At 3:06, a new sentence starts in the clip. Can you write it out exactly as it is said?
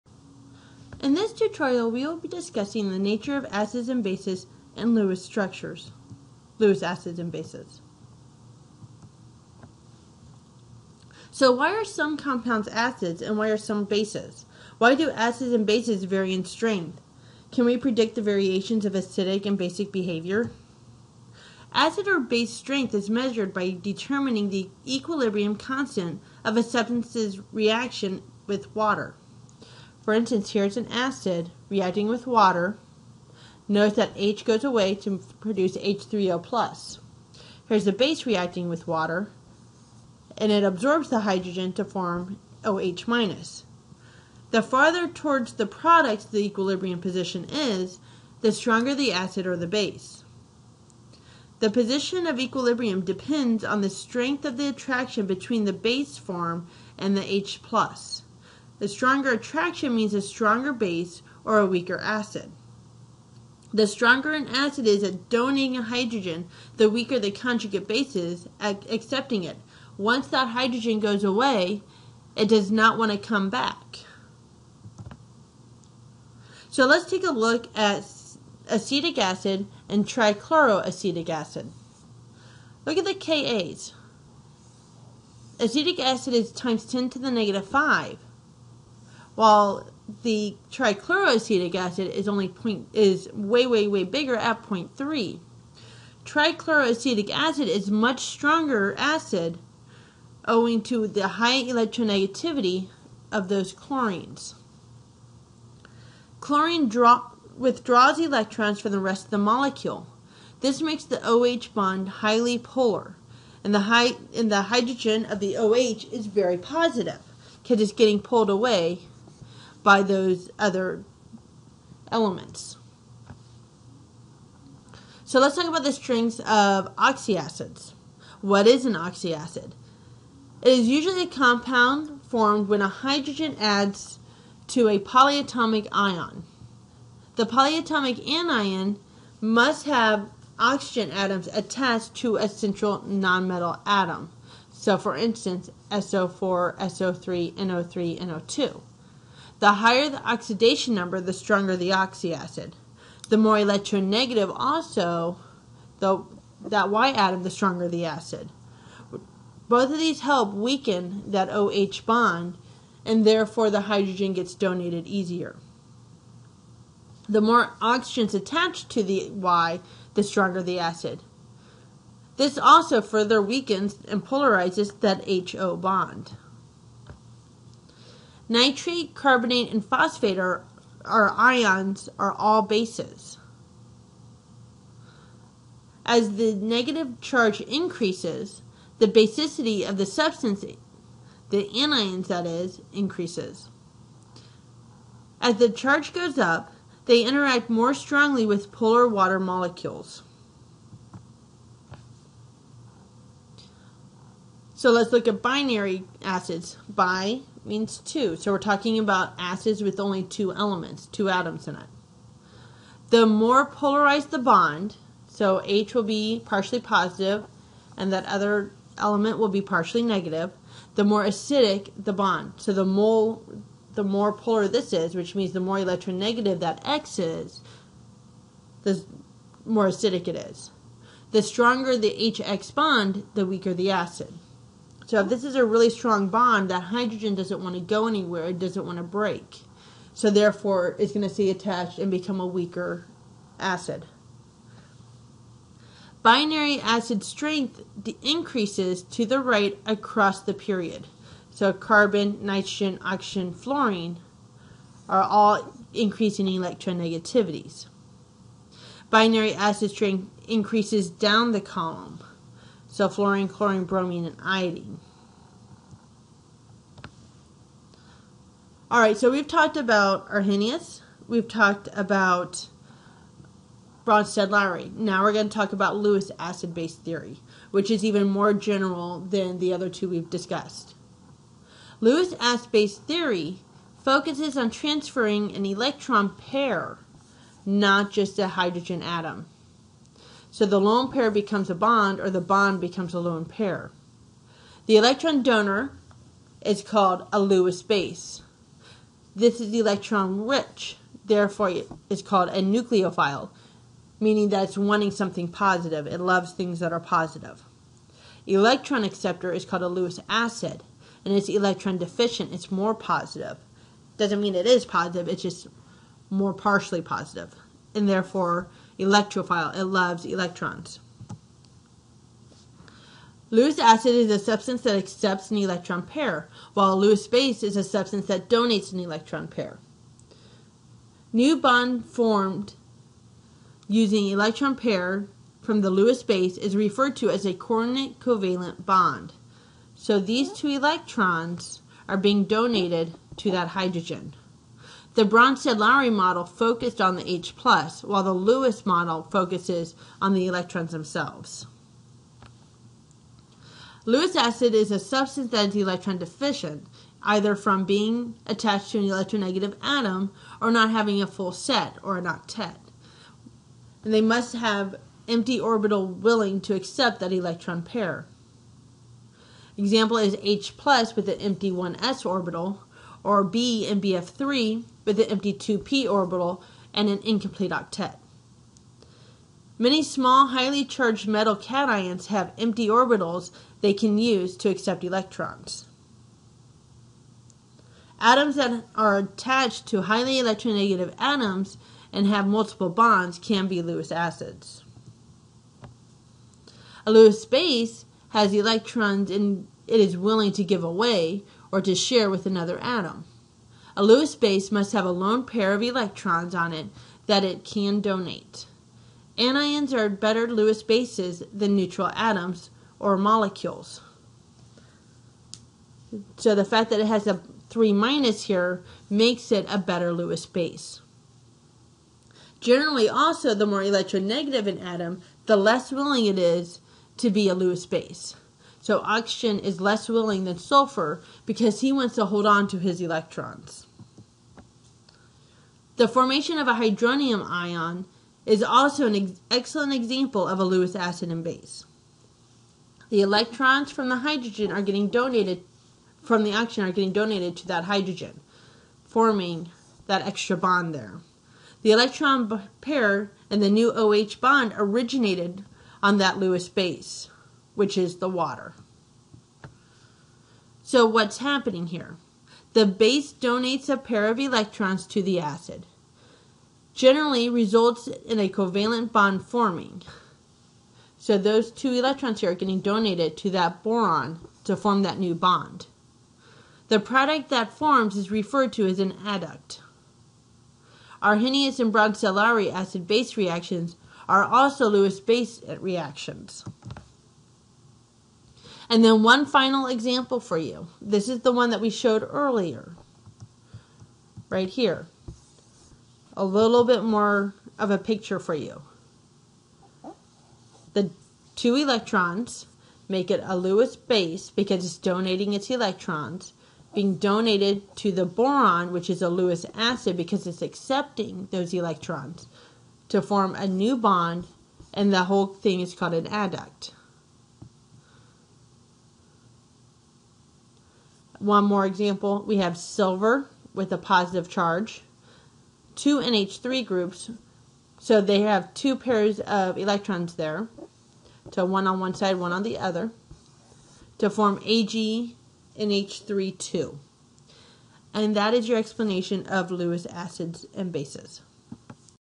As the negative charge increases, the basicity of the substance, the anions that is, increases.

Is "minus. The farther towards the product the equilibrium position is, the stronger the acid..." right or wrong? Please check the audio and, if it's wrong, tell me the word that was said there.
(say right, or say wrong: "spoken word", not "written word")
right.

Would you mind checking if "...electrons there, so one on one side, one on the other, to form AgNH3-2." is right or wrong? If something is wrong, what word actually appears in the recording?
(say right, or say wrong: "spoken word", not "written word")
right.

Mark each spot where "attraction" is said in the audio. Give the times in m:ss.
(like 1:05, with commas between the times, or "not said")
0:54, 0:59.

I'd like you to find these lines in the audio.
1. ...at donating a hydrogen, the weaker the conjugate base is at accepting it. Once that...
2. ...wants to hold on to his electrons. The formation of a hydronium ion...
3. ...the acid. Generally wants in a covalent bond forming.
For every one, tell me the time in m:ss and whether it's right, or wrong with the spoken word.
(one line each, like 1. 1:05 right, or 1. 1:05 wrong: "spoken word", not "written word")
1. 1:05 right
2. 7:11 right
3. 7:45 wrong: "results", not "wants".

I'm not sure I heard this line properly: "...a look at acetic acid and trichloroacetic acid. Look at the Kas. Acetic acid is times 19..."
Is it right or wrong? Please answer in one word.
wrong.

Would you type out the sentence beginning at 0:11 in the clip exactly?
So why are some compounds acids and why are some bases?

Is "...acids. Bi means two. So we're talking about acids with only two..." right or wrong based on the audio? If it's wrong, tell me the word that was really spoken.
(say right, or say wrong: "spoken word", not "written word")
right.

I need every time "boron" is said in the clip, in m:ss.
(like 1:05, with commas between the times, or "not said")
7:53, 8:28.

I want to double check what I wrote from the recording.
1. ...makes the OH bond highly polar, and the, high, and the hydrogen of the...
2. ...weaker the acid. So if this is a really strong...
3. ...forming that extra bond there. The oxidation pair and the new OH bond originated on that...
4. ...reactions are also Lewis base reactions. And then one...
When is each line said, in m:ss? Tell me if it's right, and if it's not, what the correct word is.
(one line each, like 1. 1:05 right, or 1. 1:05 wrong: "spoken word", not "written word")
1. 1:50 right
2. 3:53 right
3. 7:29 wrong: "electron", not "oxidation"
4. 8:03 right.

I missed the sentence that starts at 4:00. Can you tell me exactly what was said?
So therefore, it's going to stay attached and become a weaker acid.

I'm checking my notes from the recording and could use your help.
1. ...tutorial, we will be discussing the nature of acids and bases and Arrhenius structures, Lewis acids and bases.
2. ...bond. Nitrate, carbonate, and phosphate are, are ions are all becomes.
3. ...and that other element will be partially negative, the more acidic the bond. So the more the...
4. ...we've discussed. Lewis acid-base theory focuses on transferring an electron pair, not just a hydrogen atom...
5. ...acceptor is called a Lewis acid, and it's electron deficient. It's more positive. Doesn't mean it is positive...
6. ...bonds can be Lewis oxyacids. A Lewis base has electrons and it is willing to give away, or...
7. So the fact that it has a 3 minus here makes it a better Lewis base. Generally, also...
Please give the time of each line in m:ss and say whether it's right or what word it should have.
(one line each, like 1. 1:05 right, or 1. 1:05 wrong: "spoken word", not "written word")
1. 0:01 wrong: "Lewis", not "Arrhenius"
2. 2:55 wrong: "bases", not "becomes"
3. 3:37 right
4. 4:40 right
5. 5:09 right
6. 6:32 wrong: "acids", not "oxyacids"
7. 6:56 right.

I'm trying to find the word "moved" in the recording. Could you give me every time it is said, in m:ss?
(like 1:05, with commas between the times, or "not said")
not said.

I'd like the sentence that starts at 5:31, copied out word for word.
New bond formed using electron pair from the Lewis base is referred to as a coordinate covalent bond.